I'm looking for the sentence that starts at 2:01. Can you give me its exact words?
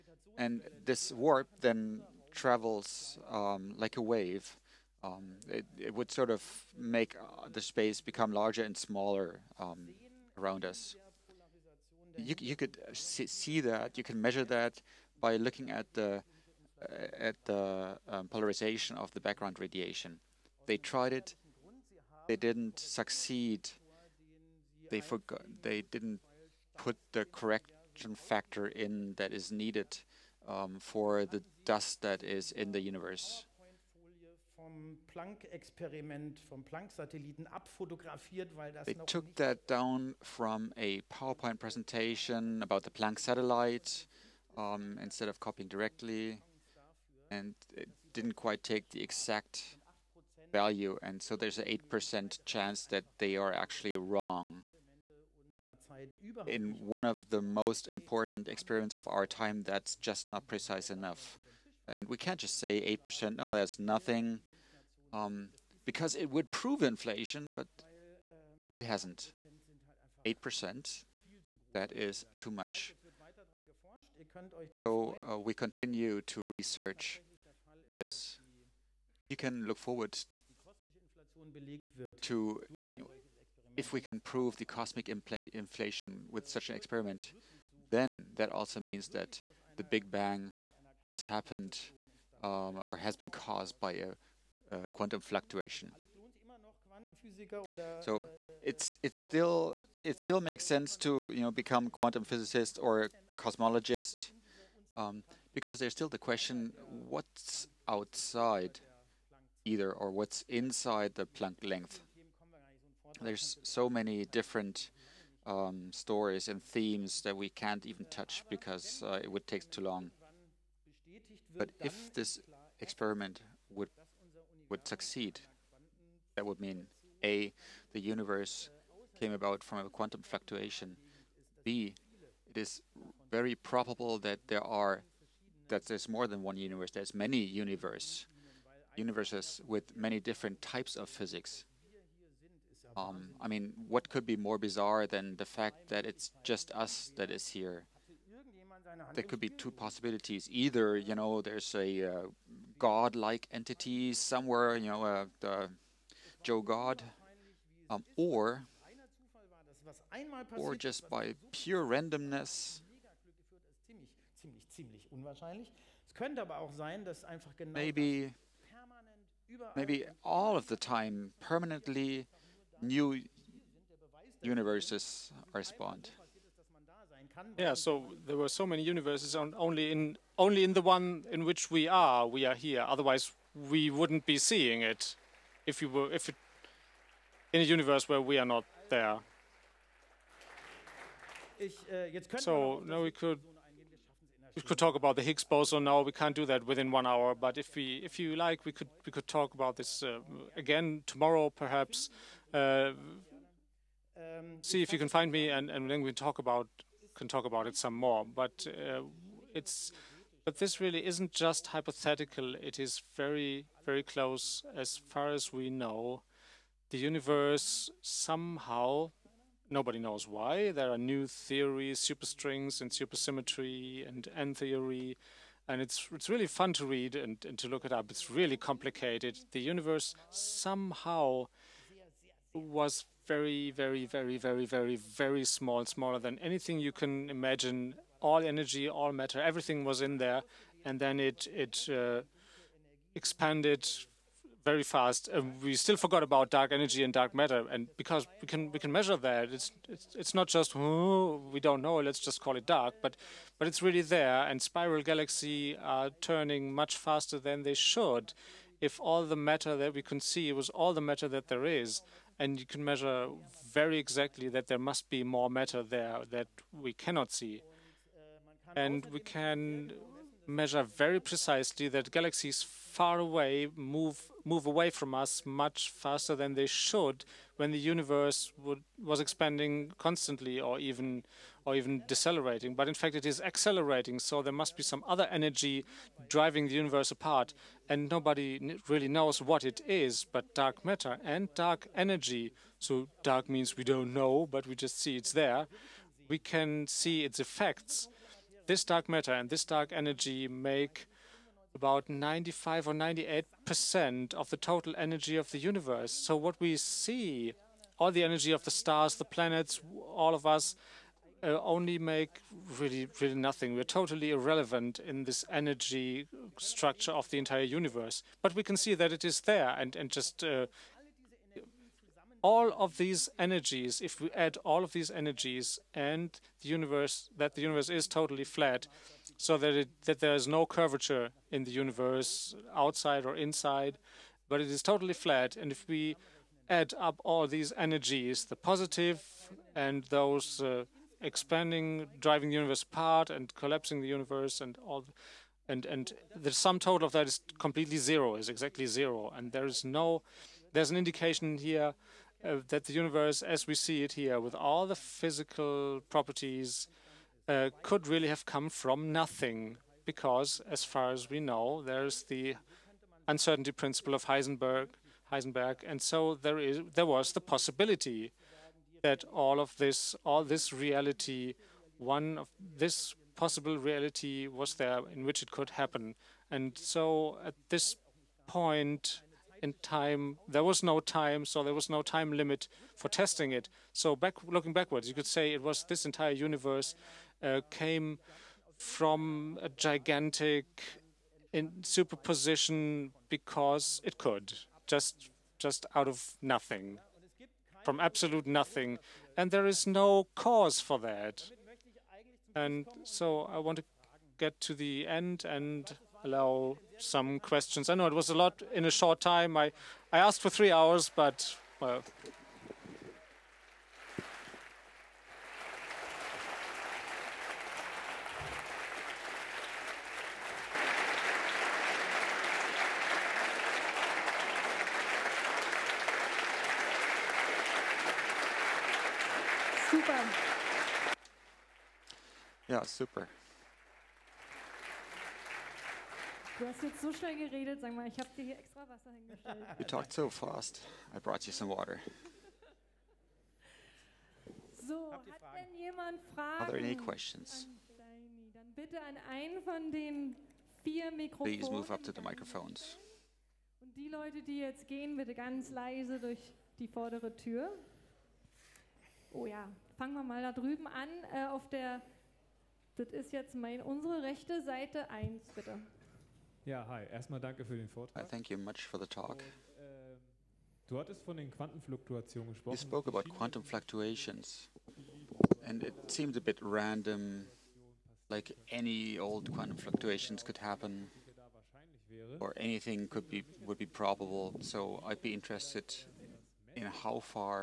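But if this experiment would would succeed, that would mean a the universe came about from a quantum fluctuation.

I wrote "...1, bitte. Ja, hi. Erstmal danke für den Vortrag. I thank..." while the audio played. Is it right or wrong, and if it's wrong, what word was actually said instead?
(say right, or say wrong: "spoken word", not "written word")
right.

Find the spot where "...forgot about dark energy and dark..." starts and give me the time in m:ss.
4:05.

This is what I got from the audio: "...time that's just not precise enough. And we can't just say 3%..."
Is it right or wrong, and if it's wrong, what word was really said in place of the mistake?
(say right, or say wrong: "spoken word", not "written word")
wrong: "8", not "3".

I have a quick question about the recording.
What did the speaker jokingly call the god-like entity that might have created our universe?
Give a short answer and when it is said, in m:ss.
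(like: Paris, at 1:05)
the Joe God, at 2:35.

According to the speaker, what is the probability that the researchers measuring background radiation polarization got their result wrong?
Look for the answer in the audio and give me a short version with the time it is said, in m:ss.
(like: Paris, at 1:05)
8%, at 0:51.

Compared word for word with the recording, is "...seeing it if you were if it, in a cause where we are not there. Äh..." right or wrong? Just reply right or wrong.
wrong.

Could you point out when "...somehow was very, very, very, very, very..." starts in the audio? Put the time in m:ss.
3:50.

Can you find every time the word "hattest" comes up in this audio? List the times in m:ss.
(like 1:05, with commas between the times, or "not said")
7:50.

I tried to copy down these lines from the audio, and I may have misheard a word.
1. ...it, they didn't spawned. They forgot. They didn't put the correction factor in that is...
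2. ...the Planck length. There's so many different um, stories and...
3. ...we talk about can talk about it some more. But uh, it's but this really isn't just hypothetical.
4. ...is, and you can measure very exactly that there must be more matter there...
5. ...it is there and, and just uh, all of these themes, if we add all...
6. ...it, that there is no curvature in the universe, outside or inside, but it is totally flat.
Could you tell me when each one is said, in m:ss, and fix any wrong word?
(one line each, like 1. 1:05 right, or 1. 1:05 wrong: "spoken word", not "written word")
1. 0:21 wrong: "succeed", not "spawned"
2. 1:51 right
3. 3:26 right
4. 4:21 right
5. 5:19 wrong: "energies", not "themes"
6. 5:29 right.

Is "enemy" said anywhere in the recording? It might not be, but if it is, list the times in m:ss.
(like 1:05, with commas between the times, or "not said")
not said.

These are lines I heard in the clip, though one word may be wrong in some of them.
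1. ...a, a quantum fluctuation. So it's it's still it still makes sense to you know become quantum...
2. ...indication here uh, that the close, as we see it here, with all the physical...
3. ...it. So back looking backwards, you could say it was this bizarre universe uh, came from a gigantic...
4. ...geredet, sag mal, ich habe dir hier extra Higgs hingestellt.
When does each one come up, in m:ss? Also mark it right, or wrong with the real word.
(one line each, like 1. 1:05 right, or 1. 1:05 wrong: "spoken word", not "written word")
1. 1:33 right
2. 5:50 wrong: "universe", not "close"
3. 6:23 wrong: "entire", not "bizarre"
4. 7:17 wrong: "Wasser", not "Higgs".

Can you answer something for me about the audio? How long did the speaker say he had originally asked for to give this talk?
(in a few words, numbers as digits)
3 hours.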